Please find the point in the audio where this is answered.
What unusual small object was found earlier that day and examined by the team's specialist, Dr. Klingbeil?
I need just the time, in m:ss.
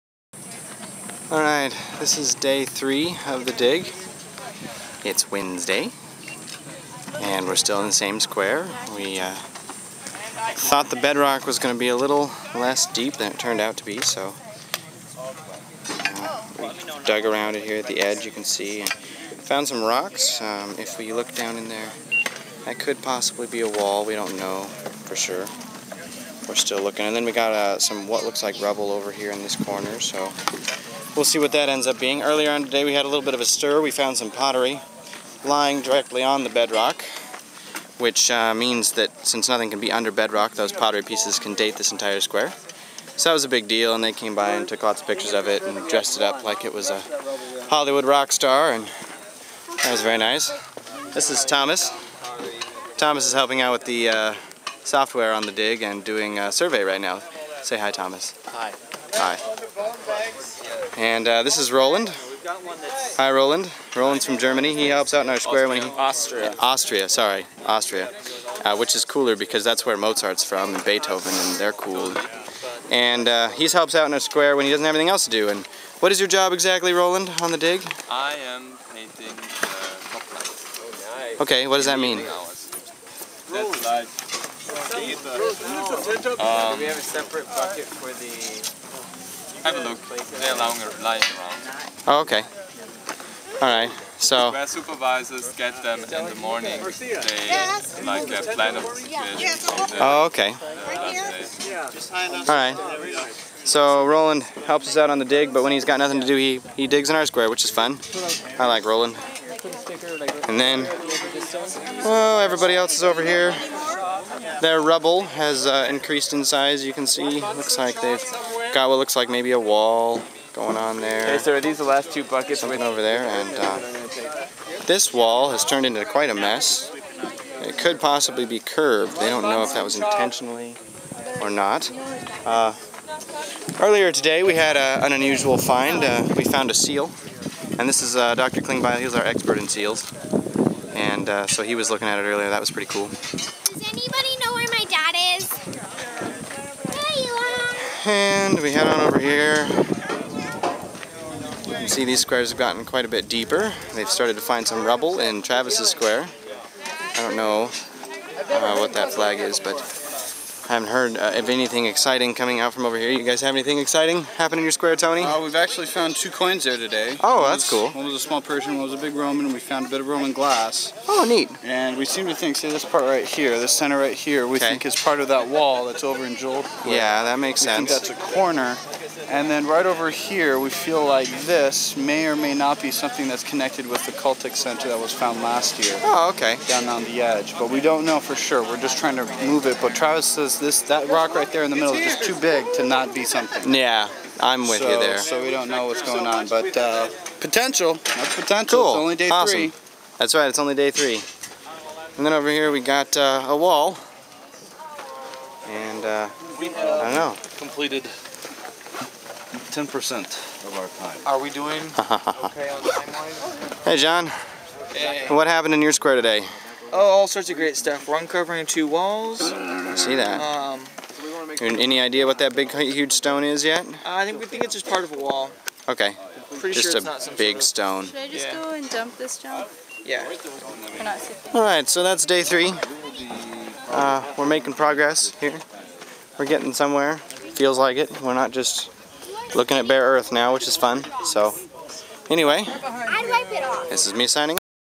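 2:16.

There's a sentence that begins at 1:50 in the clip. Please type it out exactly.
And then, oh, everybody else is over here.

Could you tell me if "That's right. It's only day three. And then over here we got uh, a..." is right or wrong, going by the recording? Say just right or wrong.
right.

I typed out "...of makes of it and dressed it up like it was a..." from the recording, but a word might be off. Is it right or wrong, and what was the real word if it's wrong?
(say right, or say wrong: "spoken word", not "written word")
wrong: "pictures", not "makes".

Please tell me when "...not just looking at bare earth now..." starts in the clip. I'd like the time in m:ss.
3:58.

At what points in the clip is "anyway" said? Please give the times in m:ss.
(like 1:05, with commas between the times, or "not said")
4:02.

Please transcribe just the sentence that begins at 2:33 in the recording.
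They've started to find some rubble in Travis's square.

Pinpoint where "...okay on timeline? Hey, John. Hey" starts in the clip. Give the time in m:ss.
3:31.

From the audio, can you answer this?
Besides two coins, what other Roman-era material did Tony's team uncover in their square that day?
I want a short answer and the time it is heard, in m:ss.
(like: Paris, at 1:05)
Roman glass, at 2:50.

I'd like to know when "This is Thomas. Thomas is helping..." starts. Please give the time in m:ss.
0:51.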